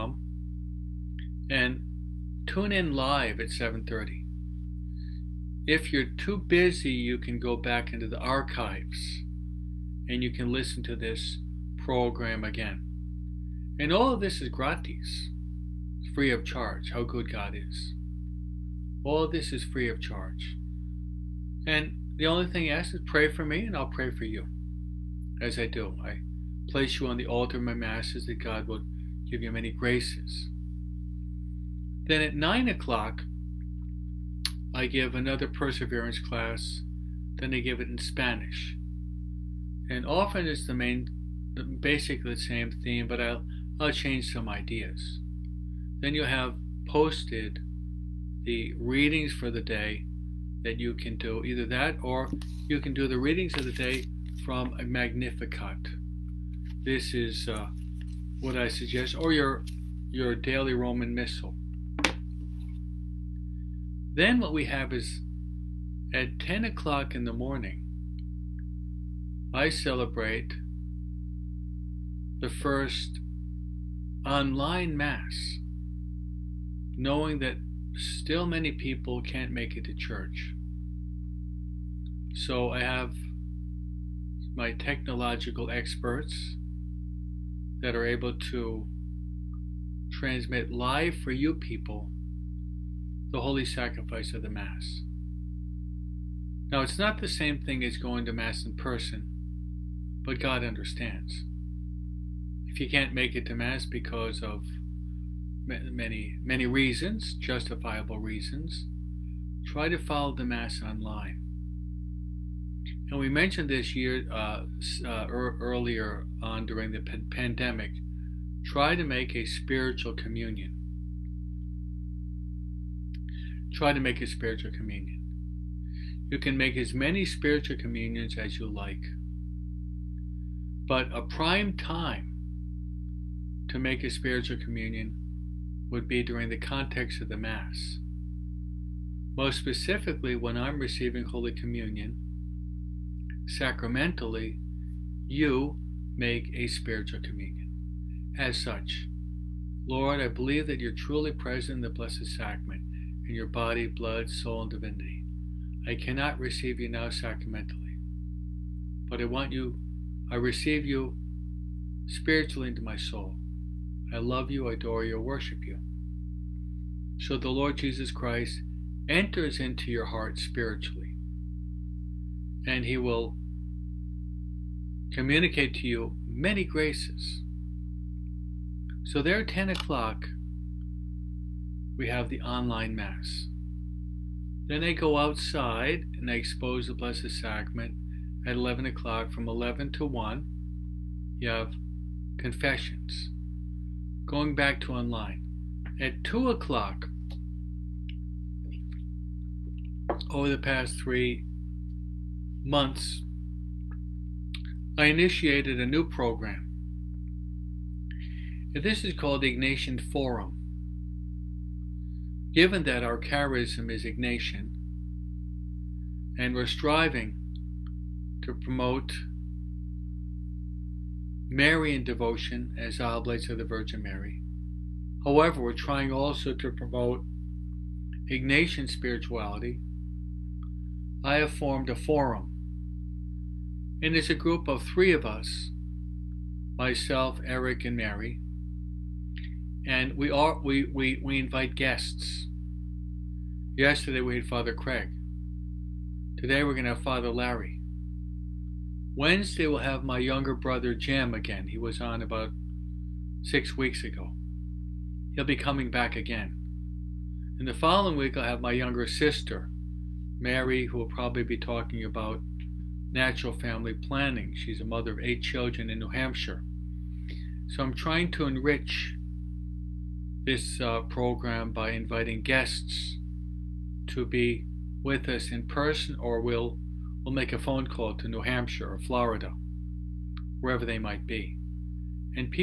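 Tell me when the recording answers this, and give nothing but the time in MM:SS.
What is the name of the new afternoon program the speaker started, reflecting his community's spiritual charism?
03:29.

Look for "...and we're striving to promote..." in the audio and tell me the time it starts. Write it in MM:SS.
03:36.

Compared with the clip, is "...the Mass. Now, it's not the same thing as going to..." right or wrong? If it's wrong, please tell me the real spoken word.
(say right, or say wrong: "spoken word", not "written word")
right.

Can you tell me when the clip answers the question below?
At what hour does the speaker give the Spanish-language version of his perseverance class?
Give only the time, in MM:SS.
00:32.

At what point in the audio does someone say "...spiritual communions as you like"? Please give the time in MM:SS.
02:07.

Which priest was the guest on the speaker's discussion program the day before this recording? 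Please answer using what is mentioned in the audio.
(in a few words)
Father Craig.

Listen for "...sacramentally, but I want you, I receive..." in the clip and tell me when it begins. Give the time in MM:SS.
02:37.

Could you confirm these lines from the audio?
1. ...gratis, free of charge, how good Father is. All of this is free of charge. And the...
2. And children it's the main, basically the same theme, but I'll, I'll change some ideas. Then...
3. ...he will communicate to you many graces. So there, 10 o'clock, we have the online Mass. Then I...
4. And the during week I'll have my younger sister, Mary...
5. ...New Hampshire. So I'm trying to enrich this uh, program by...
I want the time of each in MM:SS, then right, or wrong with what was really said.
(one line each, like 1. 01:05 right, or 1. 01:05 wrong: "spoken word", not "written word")
1. 00:14 wrong: "God", not "Father"
2. 00:39 wrong: "often", not "children"
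3. 02:52 right
4. 04:17 wrong: "following", not "during"
5. 04:25 right.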